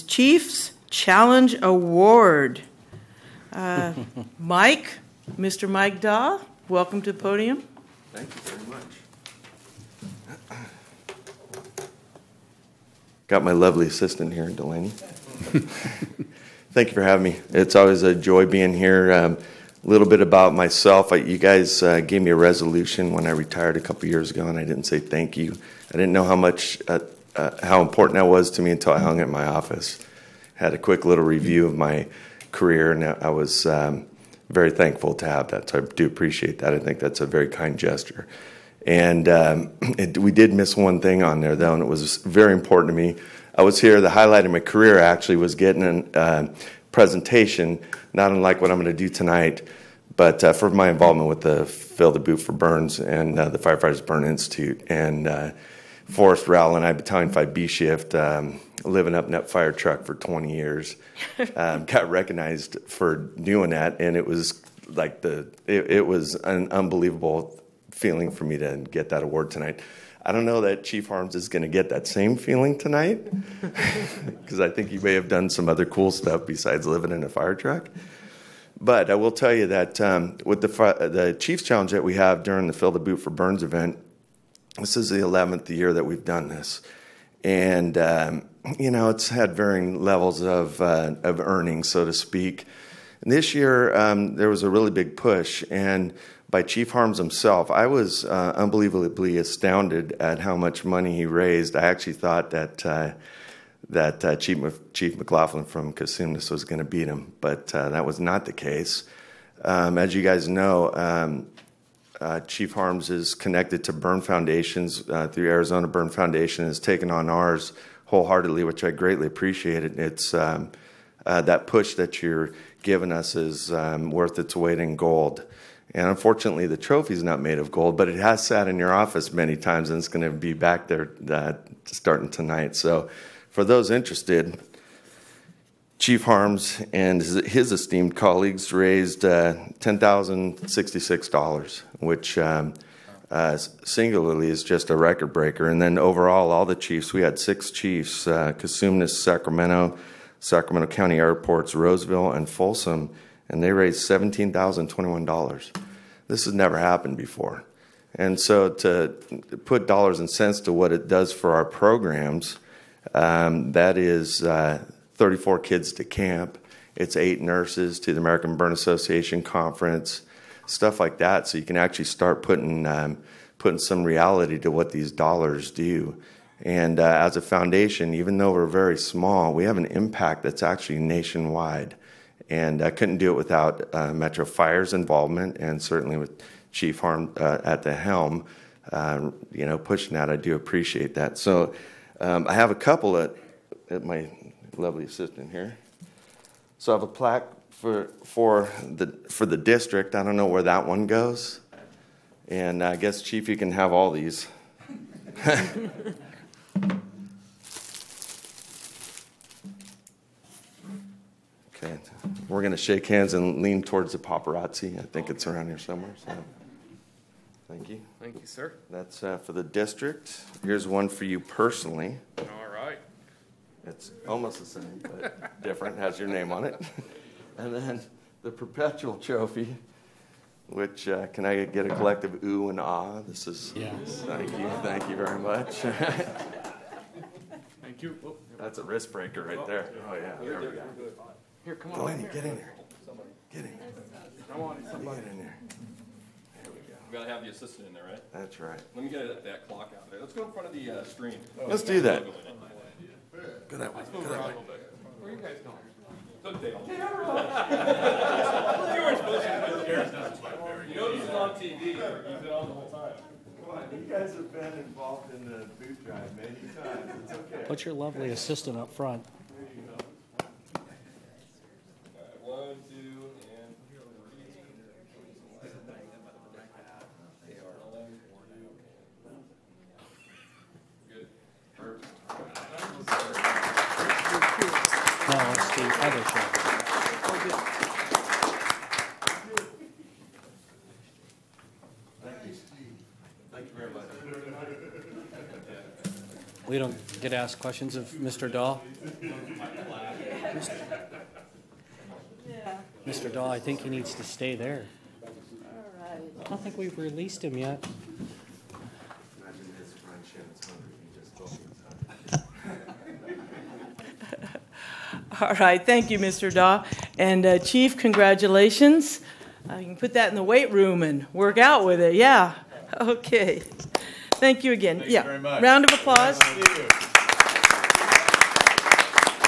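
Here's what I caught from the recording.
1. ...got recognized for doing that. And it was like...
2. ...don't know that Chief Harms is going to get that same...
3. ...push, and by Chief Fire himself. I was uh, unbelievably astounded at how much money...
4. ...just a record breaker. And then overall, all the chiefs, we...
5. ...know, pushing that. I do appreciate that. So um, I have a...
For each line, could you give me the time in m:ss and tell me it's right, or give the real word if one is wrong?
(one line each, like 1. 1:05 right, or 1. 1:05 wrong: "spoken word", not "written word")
1. 1:01 right
2. 1:10 right
3. 1:35 wrong: "Harms", not "Fire"
4. 2:24 right
5. 3:09 right.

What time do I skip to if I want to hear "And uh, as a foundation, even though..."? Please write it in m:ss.
2:56.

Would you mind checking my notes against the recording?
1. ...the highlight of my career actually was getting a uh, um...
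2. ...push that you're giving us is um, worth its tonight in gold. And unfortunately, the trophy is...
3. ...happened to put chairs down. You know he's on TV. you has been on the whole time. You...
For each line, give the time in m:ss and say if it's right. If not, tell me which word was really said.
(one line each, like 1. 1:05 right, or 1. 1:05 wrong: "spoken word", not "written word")
1. 0:44 right
2. 2:01 wrong: "weight", not "tonight"
3. 4:19 wrong: "supposed", not "happened".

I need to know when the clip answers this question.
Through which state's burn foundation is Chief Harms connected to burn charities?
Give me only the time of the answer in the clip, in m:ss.
1:55.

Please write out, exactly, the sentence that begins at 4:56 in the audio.
We don't get asked questions of Mr.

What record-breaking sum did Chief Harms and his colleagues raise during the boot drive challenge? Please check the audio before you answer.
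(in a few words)
$10,066.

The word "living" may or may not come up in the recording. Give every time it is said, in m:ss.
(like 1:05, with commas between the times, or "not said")
0:58, 1:16.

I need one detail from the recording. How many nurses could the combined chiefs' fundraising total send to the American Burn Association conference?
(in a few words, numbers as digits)
8.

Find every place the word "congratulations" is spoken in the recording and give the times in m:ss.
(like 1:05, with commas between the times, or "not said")
5:17.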